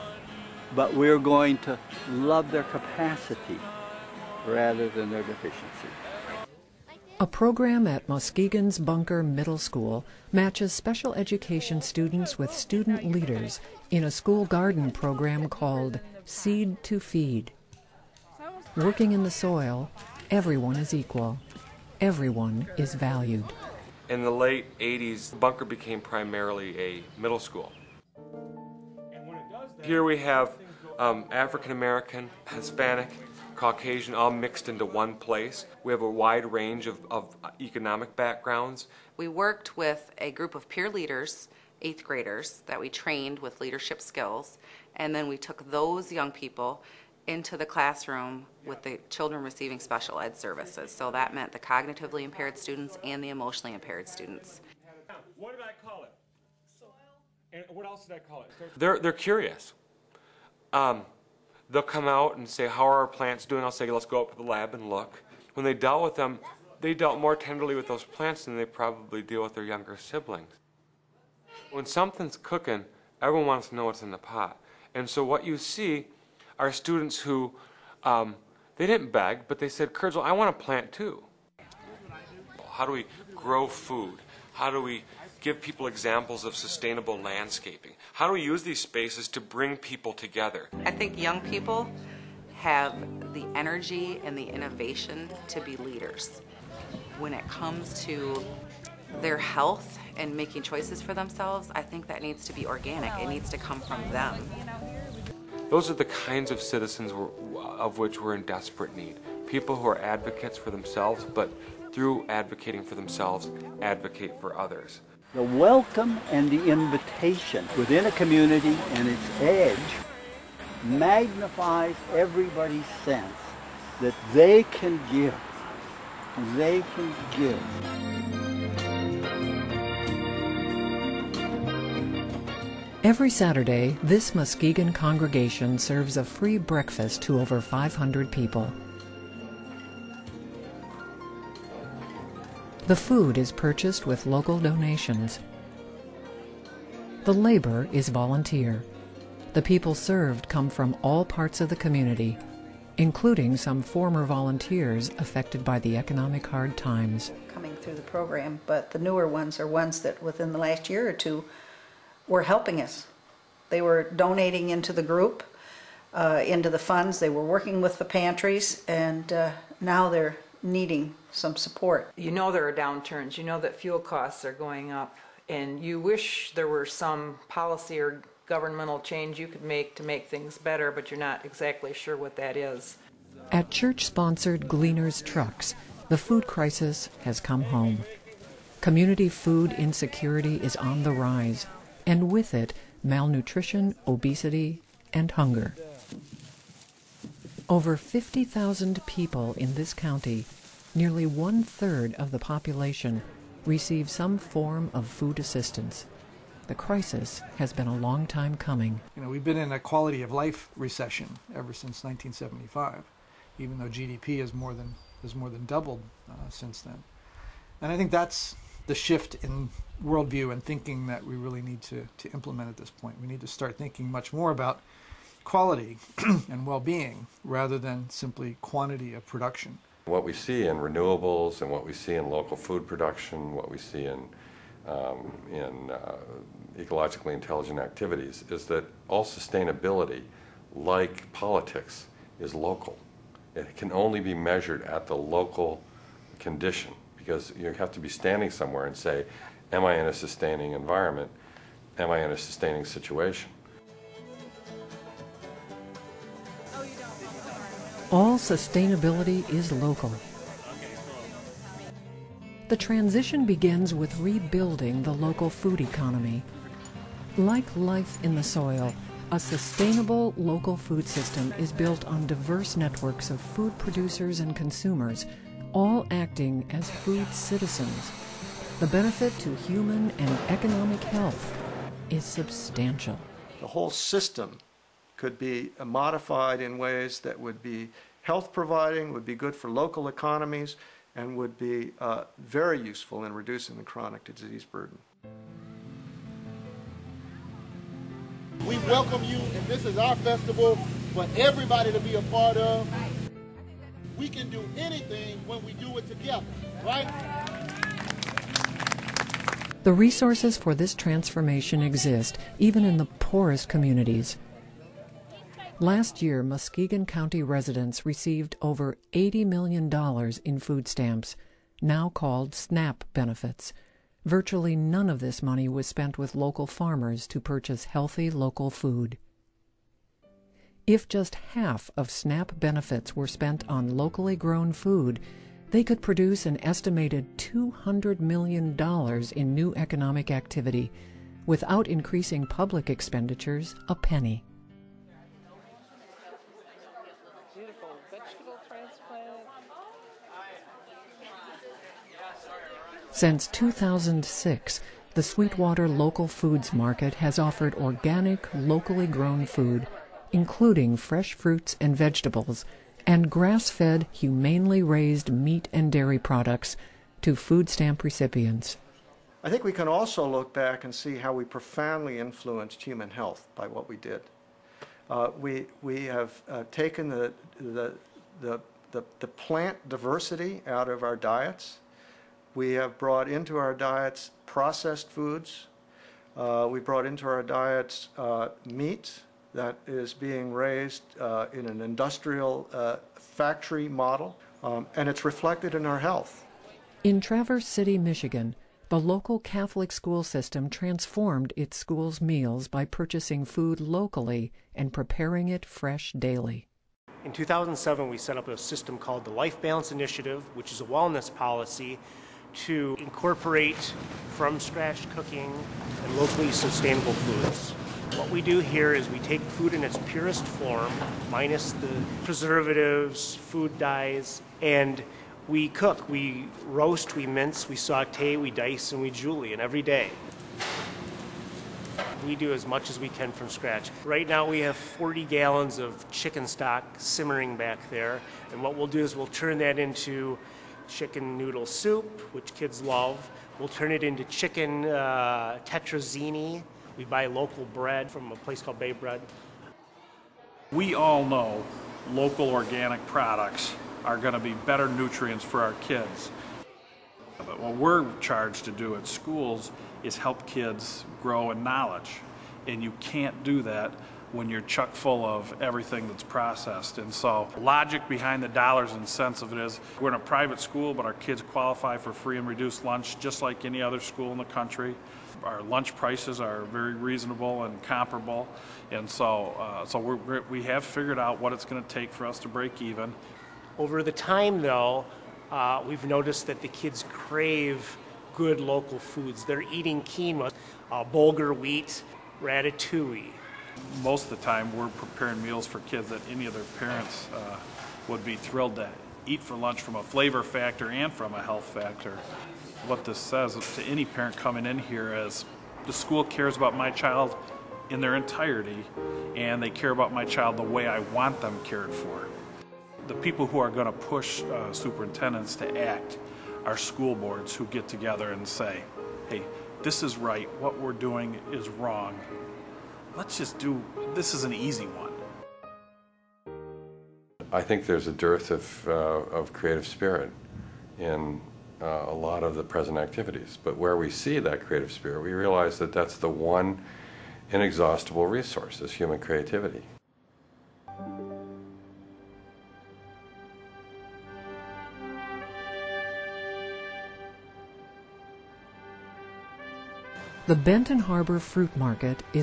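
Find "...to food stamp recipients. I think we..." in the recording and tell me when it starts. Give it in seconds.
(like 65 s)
367 s.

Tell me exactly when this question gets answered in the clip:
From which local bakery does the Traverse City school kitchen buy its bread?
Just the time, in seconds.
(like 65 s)
448 s.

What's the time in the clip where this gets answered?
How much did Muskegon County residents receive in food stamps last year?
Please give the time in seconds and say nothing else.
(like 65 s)
318 s.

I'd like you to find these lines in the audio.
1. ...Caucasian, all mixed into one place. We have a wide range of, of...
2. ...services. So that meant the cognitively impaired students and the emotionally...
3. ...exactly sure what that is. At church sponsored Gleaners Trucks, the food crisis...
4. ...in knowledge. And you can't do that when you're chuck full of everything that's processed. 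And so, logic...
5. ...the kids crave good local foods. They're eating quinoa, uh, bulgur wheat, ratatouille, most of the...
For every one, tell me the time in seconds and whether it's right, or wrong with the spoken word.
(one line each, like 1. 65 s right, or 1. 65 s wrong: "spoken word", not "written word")
1. 33 s right
2. 50 s right
3. 181 s right
4. 461 s right
5. 486 s right.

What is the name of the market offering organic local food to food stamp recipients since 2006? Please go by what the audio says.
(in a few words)
Sweetwater Local Foods Market.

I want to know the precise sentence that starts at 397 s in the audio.
In Traverse City, Michigan, the local Catholic school system transformed its school's meals by purchasing food locally and preparing it fresh daily.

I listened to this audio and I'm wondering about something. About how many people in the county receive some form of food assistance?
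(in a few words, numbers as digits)
Over 50,000.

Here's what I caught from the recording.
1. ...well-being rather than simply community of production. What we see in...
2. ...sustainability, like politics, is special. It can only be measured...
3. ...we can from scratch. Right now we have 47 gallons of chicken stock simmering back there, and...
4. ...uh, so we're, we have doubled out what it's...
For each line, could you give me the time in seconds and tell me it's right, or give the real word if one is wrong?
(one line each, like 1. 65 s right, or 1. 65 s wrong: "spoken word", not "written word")
1. 226 s wrong: "quantity", not "community"
2. 239 s wrong: "local", not "special"
3. 432 s wrong: "40", not "47"
4. 479 s wrong: "figured", not "doubled".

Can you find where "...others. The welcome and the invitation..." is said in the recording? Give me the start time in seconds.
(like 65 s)
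114 s.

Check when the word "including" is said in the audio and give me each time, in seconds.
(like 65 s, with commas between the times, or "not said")
152 s, 360 s.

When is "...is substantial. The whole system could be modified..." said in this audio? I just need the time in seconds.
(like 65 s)
282 s.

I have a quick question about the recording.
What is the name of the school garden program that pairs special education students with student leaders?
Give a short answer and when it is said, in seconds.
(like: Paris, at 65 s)
Seed to Feed, at 16 s.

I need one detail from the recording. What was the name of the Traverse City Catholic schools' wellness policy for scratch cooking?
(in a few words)
Life Balance Initiative.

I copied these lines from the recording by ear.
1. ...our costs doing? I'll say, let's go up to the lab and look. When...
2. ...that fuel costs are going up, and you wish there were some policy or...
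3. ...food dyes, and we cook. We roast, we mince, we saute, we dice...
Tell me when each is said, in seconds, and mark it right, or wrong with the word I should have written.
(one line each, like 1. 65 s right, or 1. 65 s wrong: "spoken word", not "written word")
1. 62 s wrong: "plants", not "costs"
2. 173 s right
3. 423 s right.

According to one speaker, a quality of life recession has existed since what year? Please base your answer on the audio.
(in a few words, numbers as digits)
1975.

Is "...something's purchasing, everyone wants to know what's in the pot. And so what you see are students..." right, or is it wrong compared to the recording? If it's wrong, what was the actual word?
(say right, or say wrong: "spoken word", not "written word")
wrong: "cooking", not "purchasing".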